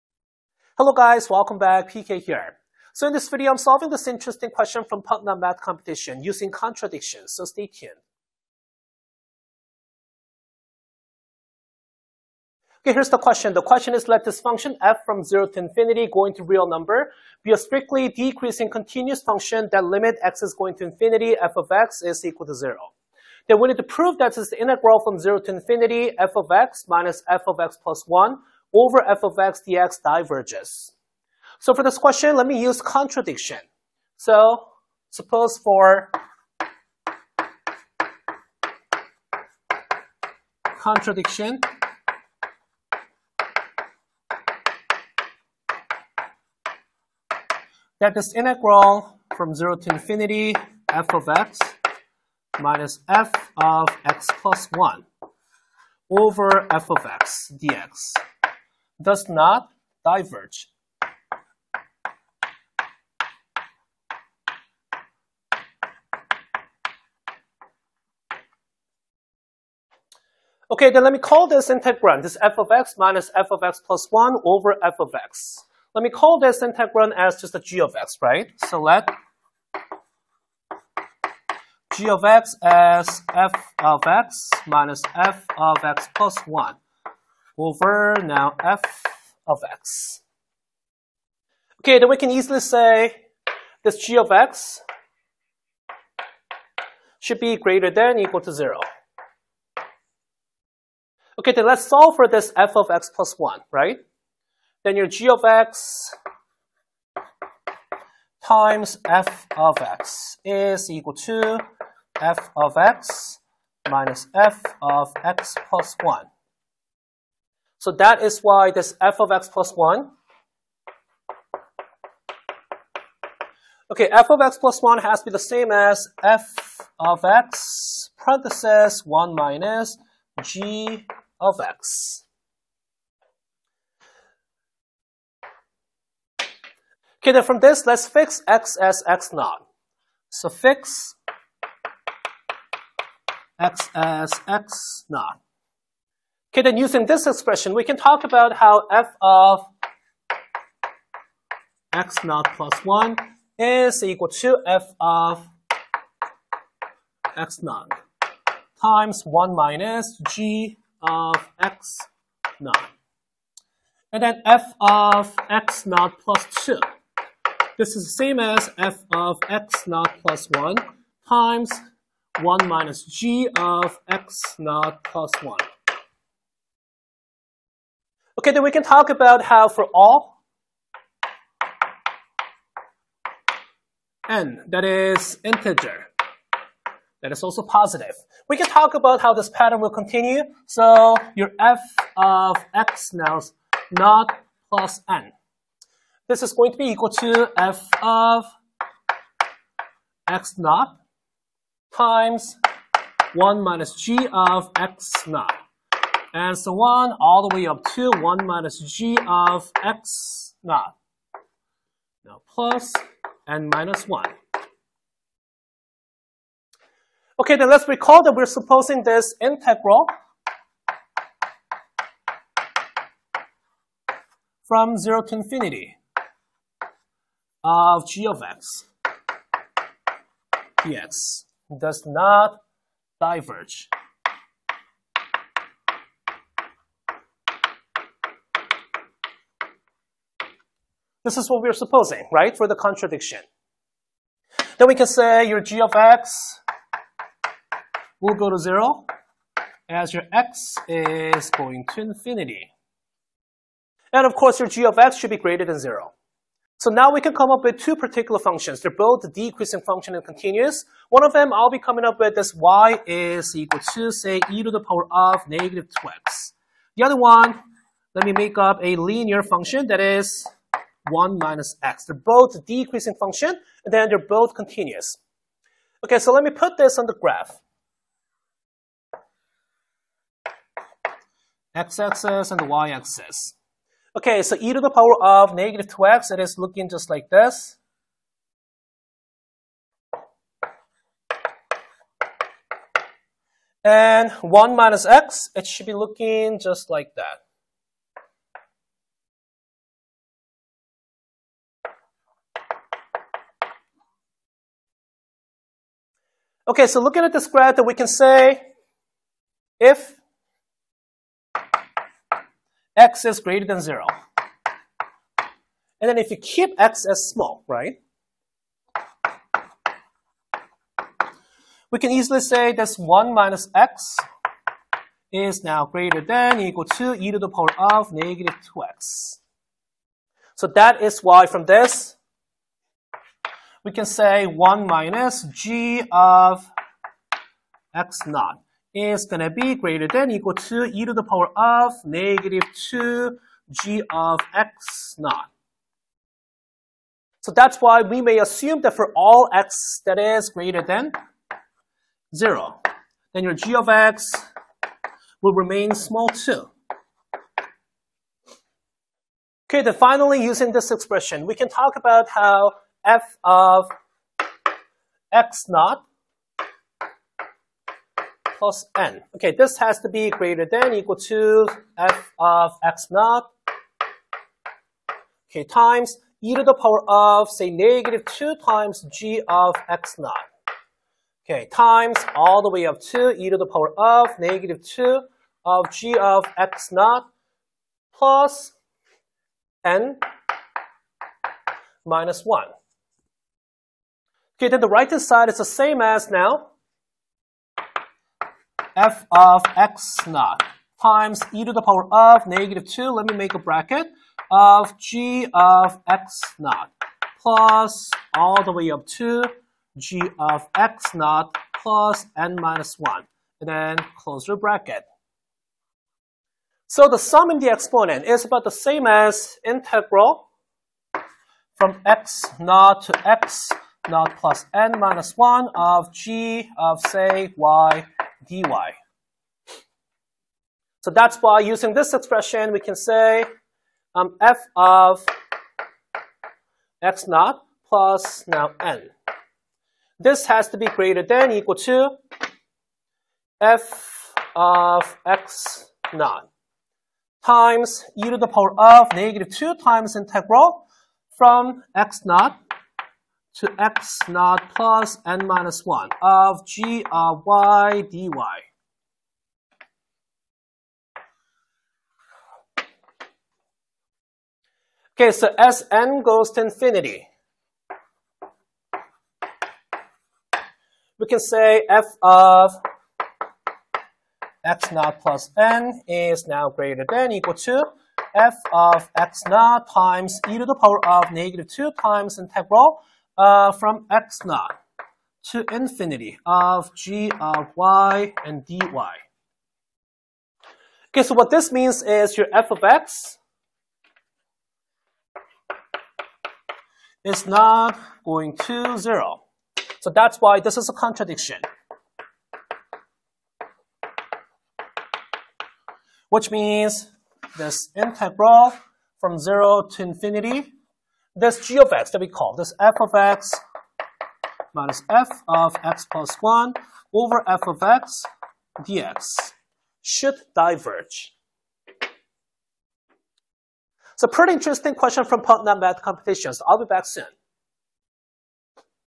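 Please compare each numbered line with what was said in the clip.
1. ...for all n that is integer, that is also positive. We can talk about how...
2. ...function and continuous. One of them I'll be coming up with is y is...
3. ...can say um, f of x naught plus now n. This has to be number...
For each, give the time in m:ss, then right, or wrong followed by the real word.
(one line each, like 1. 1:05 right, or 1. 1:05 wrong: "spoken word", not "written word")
1. 2:59 right
2. 4:19 right
3. 7:12 wrong: "greater", not "number".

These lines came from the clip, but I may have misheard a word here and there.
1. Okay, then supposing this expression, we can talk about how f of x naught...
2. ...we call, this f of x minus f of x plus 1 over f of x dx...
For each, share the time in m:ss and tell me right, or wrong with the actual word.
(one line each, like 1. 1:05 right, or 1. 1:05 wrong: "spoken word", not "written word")
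1. 2:26 wrong: "using", not "supposing"
2. 8:32 right.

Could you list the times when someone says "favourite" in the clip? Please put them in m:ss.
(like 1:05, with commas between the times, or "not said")
not said.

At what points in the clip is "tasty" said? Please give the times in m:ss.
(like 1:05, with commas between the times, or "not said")
not said.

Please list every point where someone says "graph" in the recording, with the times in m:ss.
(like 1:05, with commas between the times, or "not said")
4:37, 5:07.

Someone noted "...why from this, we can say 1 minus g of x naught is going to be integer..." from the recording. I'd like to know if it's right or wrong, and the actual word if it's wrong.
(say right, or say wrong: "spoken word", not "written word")
wrong: "greater", not "integer".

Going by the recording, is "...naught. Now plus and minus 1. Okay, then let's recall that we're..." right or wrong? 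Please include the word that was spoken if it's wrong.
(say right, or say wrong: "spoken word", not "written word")
right.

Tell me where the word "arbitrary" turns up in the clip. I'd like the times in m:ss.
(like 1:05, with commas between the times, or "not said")
not said.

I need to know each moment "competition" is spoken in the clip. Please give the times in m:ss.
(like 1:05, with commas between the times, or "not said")
0:05, 8:46.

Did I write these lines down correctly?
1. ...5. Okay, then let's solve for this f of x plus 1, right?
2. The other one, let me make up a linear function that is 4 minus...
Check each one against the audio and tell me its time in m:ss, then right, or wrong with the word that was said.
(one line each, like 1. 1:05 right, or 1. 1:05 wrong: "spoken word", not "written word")
1. 1:38 wrong: "0", not "5"
2. 4:26 wrong: "1", not "4".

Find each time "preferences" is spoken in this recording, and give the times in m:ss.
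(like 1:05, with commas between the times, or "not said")
not said.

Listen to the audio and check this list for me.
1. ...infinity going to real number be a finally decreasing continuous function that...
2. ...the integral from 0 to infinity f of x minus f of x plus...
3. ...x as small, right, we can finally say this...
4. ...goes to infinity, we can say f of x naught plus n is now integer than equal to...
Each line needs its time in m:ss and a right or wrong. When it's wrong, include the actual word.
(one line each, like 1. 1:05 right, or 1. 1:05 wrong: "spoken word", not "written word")
1. 0:15 wrong: "strictly", not "finally"
2. 0:24 right
3. 5:16 wrong: "easily", not "finally"
4. 7:46 wrong: "greater", not "integer".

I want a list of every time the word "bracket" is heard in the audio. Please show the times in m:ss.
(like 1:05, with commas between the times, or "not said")
6:43, 6:54.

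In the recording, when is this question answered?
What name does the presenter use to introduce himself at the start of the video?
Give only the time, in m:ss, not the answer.
0:01.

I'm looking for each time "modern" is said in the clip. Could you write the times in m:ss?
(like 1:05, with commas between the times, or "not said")
not said.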